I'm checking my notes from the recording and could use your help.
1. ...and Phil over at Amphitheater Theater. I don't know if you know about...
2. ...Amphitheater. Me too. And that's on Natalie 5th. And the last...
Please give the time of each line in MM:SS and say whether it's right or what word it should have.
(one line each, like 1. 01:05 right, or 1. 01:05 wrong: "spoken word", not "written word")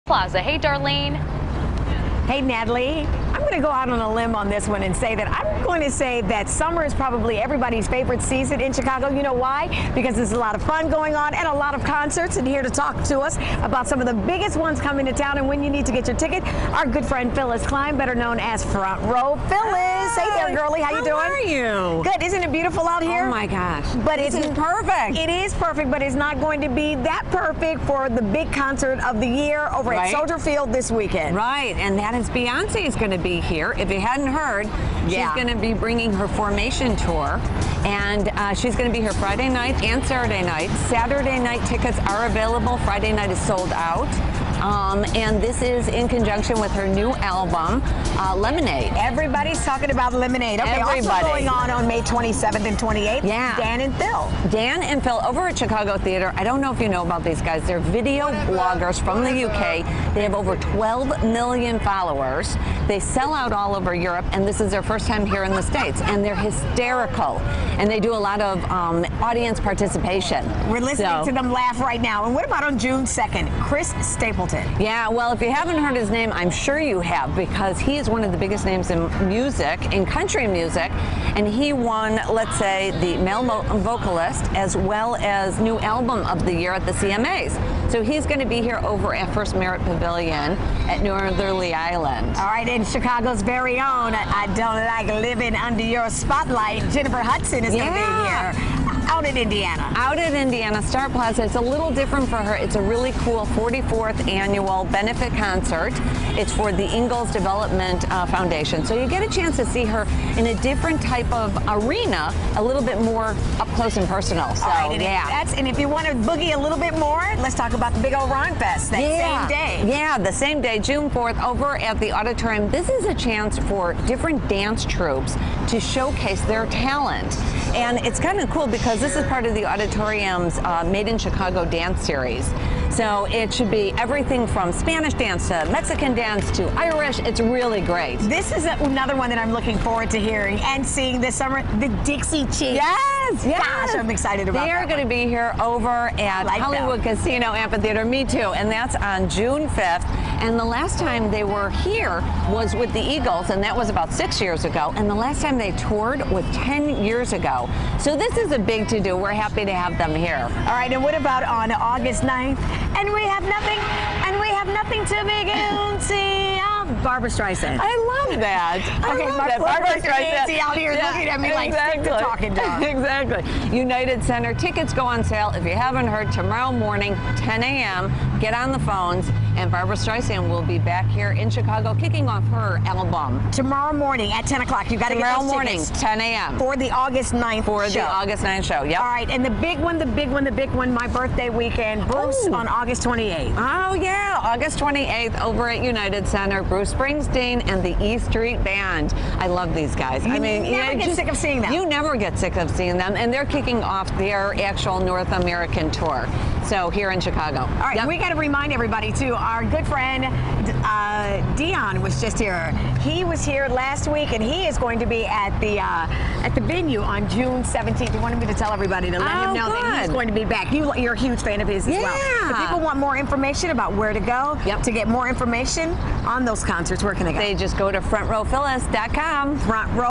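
1. 00:54 wrong: "Chicago", not "Amphitheater"
2. 02:27 wrong: "June", not "Natalie".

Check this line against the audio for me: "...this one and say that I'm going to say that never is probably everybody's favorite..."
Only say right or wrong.
wrong.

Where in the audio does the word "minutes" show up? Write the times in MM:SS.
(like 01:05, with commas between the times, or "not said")
not said.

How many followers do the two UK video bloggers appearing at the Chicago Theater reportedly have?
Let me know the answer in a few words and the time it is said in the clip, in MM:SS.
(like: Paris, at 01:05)
12 million, at 01:00.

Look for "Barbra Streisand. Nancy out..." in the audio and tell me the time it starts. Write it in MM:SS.
02:49.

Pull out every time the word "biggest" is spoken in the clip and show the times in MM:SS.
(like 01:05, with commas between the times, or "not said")
00:14, 01:18.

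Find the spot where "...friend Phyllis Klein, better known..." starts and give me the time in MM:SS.
00:17.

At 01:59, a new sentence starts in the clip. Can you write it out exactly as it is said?
Yeah, the same day, June 4th, over at the auditorium.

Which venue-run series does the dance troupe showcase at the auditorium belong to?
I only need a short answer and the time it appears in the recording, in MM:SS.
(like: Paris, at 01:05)
Made in Chicago, at 02:10.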